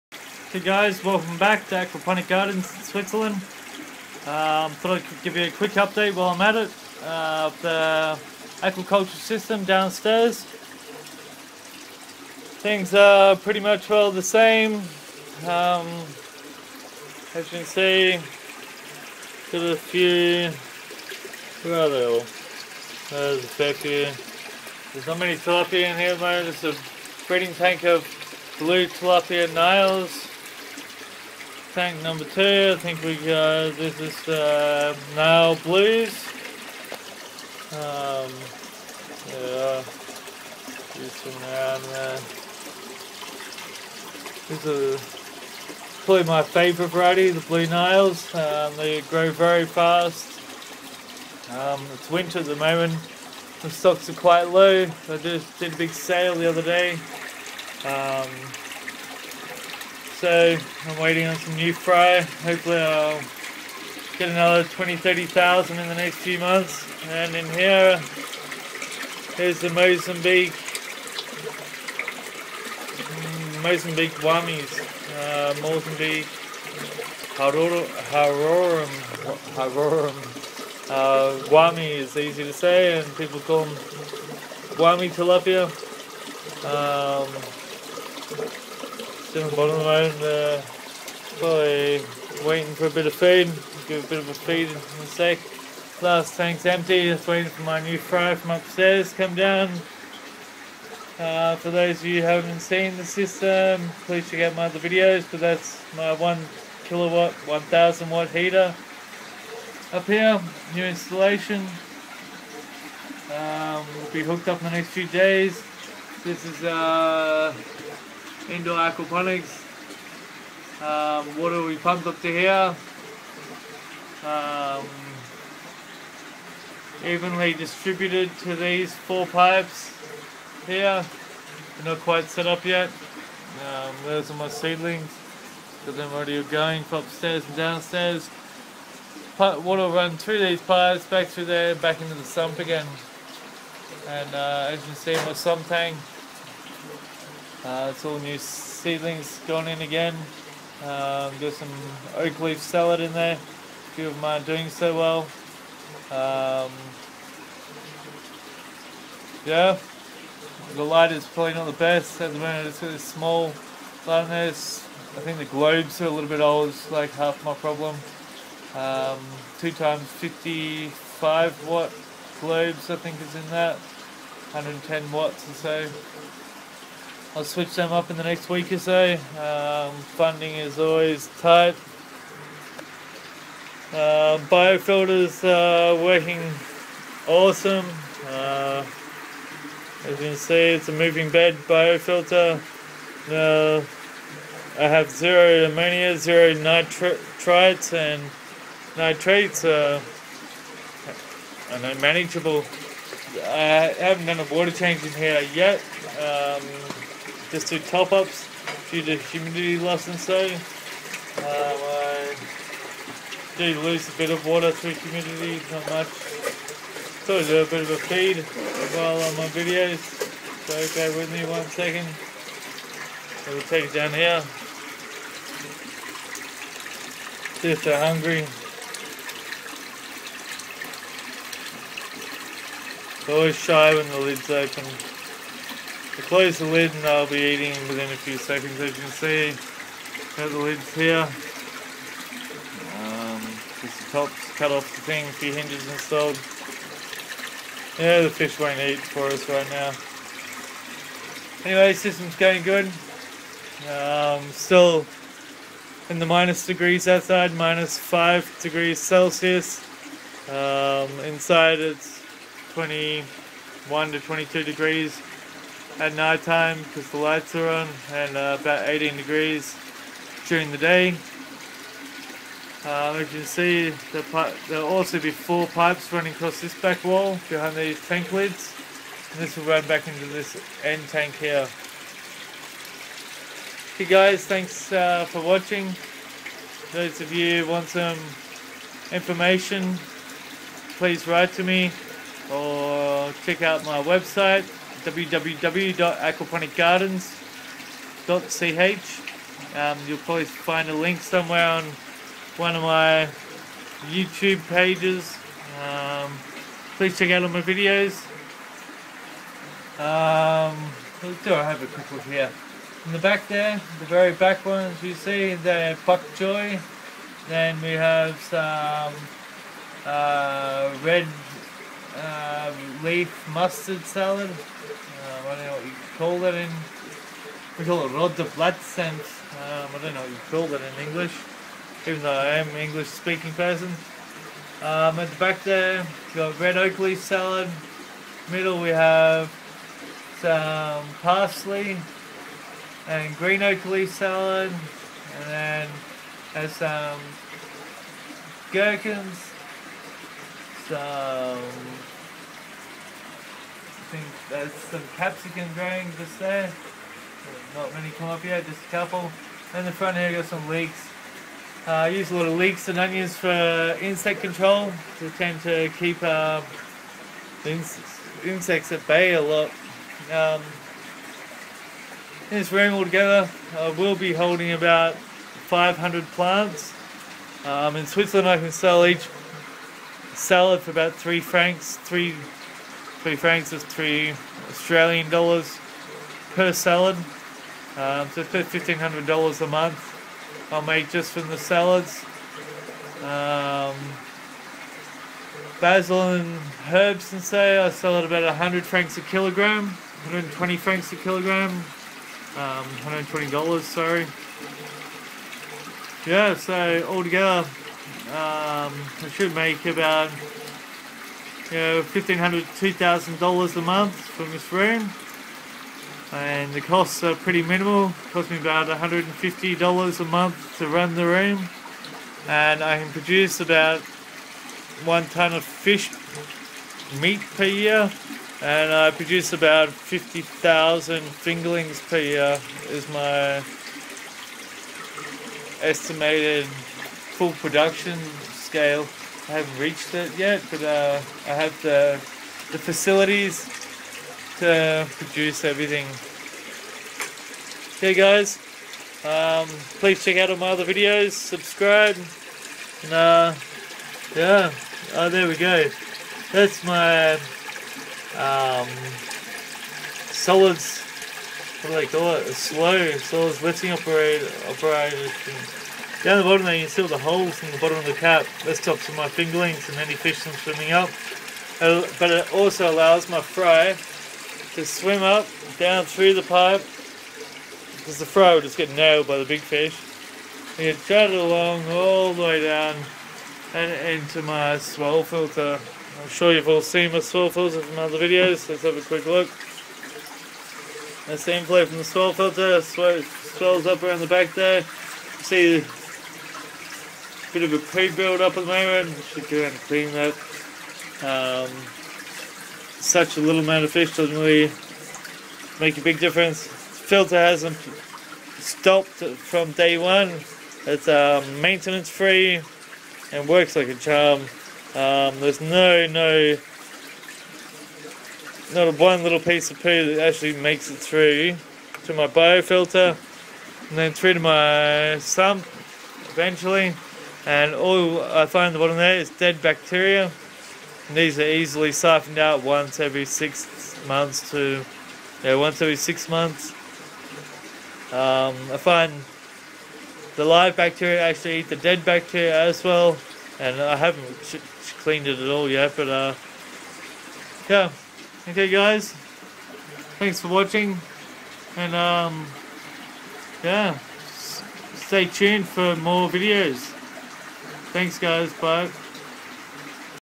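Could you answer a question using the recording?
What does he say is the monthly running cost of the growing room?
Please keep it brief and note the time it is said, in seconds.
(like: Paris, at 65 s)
$150, at 418 s.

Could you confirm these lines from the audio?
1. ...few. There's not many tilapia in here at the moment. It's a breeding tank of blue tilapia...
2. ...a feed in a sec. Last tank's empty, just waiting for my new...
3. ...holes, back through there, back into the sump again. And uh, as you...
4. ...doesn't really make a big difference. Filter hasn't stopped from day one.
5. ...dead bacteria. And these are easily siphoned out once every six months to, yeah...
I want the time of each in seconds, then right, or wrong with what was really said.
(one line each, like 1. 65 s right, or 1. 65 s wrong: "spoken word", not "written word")
1. 23 s right
2. 94 s right
3. 140 s wrong: "pipes", not "holes"
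4. 504 s right
5. 529 s right.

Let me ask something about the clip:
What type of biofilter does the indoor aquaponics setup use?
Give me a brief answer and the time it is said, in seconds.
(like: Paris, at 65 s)
moving bed biofilter, at 190 s.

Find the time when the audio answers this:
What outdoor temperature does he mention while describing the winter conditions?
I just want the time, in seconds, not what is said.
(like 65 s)
257 s.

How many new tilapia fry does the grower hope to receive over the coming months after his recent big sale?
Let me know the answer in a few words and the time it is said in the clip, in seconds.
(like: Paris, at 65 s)
20,000 to 30,000, at 64 s.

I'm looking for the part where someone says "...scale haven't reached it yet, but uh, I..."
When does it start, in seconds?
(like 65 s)
438 s.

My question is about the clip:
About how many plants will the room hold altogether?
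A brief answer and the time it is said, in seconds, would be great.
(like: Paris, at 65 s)
500, at 375 s.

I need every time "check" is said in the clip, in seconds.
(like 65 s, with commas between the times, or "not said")
104 s, 293 s, 307 s, 450 s.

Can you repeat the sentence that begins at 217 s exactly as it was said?
So I do a bit of a feed while on my videos.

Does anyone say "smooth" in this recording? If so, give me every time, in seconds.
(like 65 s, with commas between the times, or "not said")
not said.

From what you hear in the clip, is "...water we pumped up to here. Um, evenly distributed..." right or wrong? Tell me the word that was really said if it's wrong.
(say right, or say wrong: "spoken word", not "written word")
right.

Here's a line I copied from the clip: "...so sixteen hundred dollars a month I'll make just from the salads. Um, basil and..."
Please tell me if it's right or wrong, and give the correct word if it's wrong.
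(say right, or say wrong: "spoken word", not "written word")
wrong: "fifteen", not "sixteen".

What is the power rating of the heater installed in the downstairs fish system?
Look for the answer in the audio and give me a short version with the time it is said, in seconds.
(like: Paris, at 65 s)
1 kilowatt, at 106 s.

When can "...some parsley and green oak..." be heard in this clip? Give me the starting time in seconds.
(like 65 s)
340 s.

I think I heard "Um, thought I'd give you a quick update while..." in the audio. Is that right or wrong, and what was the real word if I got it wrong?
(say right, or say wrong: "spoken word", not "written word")
right.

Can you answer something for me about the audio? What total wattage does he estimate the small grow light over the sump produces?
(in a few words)
110 watts.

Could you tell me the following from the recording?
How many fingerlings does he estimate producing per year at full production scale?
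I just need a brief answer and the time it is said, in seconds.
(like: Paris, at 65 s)
50,000, at 429 s.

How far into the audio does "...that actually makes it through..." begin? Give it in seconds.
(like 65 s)
520 s.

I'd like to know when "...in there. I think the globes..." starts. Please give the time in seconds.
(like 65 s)
164 s.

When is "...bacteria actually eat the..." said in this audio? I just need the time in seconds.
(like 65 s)
540 s.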